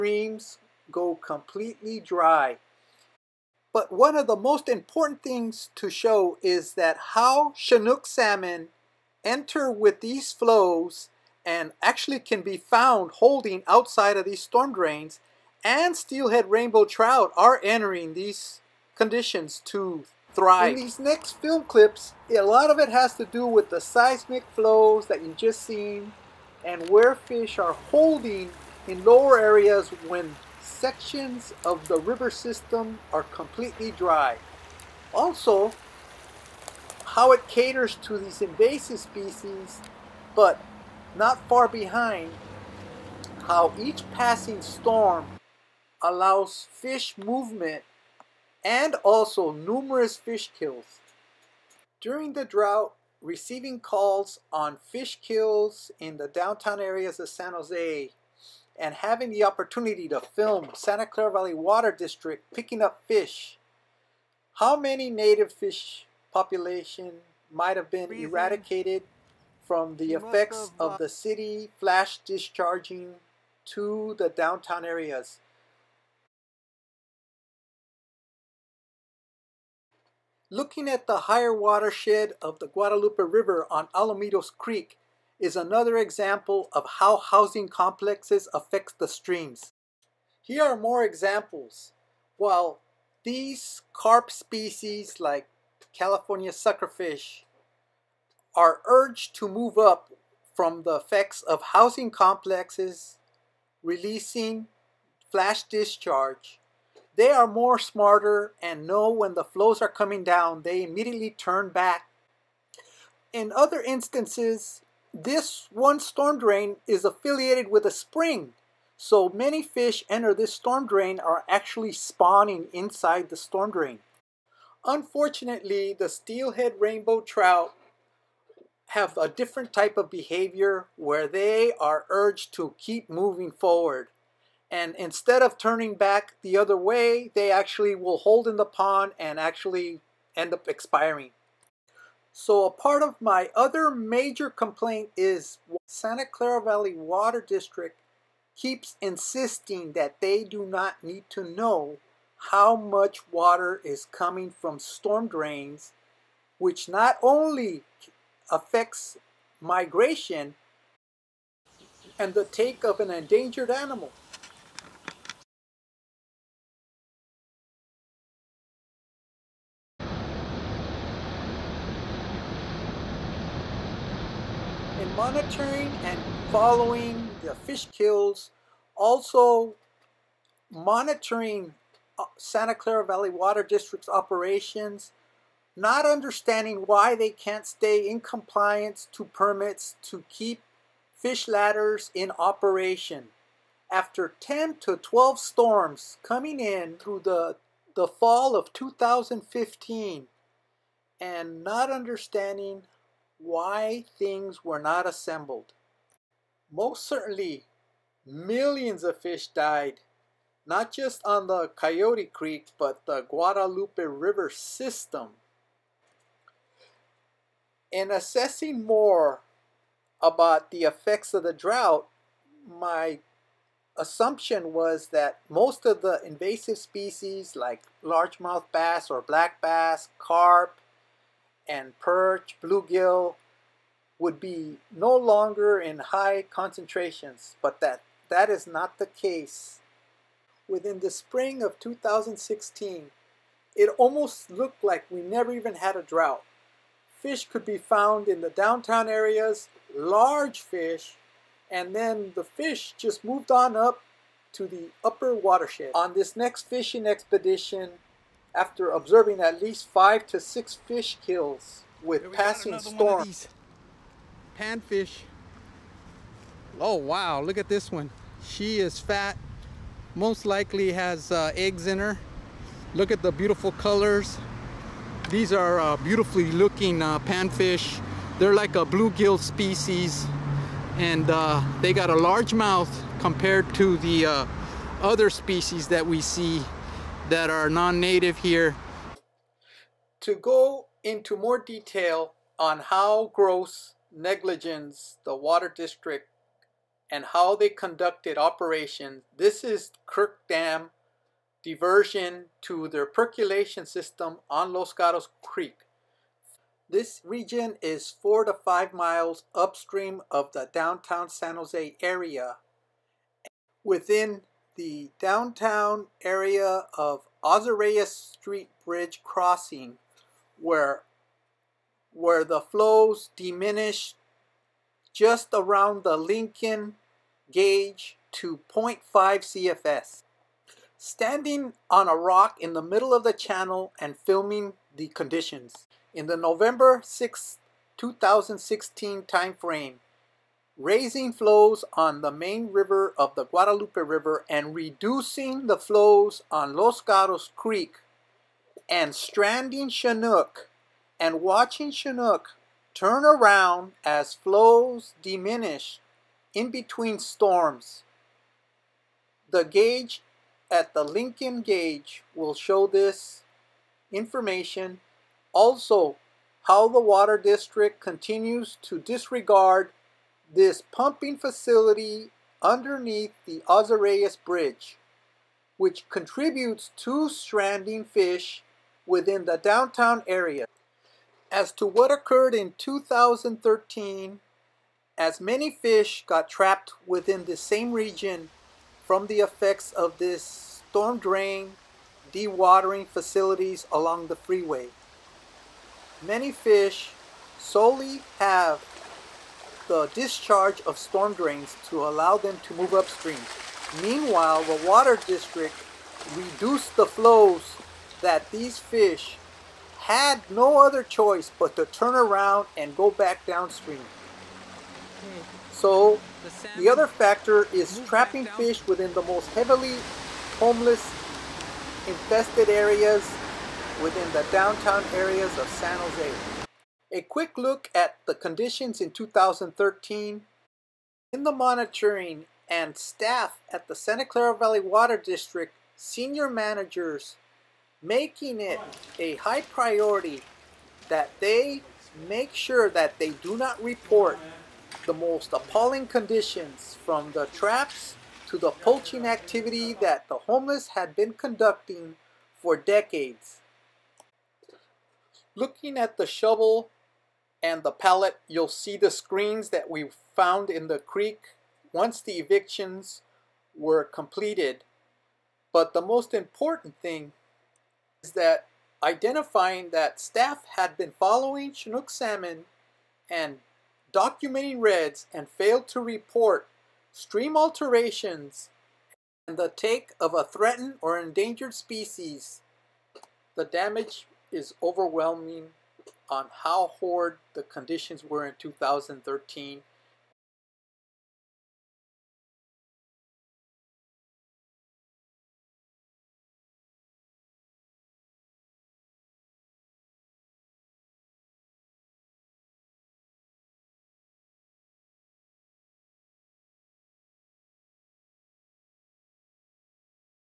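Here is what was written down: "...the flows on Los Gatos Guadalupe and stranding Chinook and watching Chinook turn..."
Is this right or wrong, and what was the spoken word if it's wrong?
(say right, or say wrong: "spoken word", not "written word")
wrong: "Creek", not "Guadalupe".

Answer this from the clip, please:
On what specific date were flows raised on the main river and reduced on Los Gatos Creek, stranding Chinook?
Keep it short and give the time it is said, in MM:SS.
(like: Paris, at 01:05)
November 6, 2016, at 05:36.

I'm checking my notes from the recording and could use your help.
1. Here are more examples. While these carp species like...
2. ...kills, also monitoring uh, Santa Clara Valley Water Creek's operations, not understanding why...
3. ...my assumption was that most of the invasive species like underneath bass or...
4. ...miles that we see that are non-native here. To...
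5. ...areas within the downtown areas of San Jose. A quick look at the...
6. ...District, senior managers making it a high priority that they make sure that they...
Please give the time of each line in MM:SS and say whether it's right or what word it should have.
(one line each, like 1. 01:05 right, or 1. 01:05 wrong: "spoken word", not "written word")
1. 01:30 right
2. 02:57 wrong: "District", not "Creek"
3. 03:42 wrong: "largemouth", not "underneath"
4. 04:45 wrong: "species", not "miles"
5. 07:02 right
6. 07:15 right.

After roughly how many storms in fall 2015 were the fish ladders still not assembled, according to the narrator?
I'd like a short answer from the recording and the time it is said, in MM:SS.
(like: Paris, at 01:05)
10 to 12, at 03:14.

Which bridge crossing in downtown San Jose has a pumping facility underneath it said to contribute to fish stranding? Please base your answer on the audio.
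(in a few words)
Auzerais Bridge.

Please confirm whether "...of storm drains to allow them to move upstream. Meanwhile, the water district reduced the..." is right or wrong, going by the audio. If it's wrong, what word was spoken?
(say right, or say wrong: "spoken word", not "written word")
right.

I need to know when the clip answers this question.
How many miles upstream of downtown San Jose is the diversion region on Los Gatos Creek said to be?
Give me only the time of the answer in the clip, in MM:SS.
05:08.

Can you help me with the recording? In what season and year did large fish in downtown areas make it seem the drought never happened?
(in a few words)
spring of 2016.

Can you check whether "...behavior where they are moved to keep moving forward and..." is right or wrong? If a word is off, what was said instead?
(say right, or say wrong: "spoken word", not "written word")
wrong: "urged", not "moved".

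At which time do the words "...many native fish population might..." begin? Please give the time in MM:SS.
01:04.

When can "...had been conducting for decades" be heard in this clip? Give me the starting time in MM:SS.
07:30.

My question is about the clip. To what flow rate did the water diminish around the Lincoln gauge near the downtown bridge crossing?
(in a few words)
0.5 CFS.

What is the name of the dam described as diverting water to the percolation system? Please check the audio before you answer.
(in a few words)
Kirk Dam.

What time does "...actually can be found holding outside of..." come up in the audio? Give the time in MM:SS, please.
00:11.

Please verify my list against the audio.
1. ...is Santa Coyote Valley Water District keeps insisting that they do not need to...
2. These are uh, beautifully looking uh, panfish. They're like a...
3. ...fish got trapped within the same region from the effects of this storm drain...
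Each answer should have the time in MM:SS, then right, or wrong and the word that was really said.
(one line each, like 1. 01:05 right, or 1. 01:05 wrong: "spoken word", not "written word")
1. 02:25 wrong: "Clara", not "Coyote"
2. 04:35 right
3. 06:25 right.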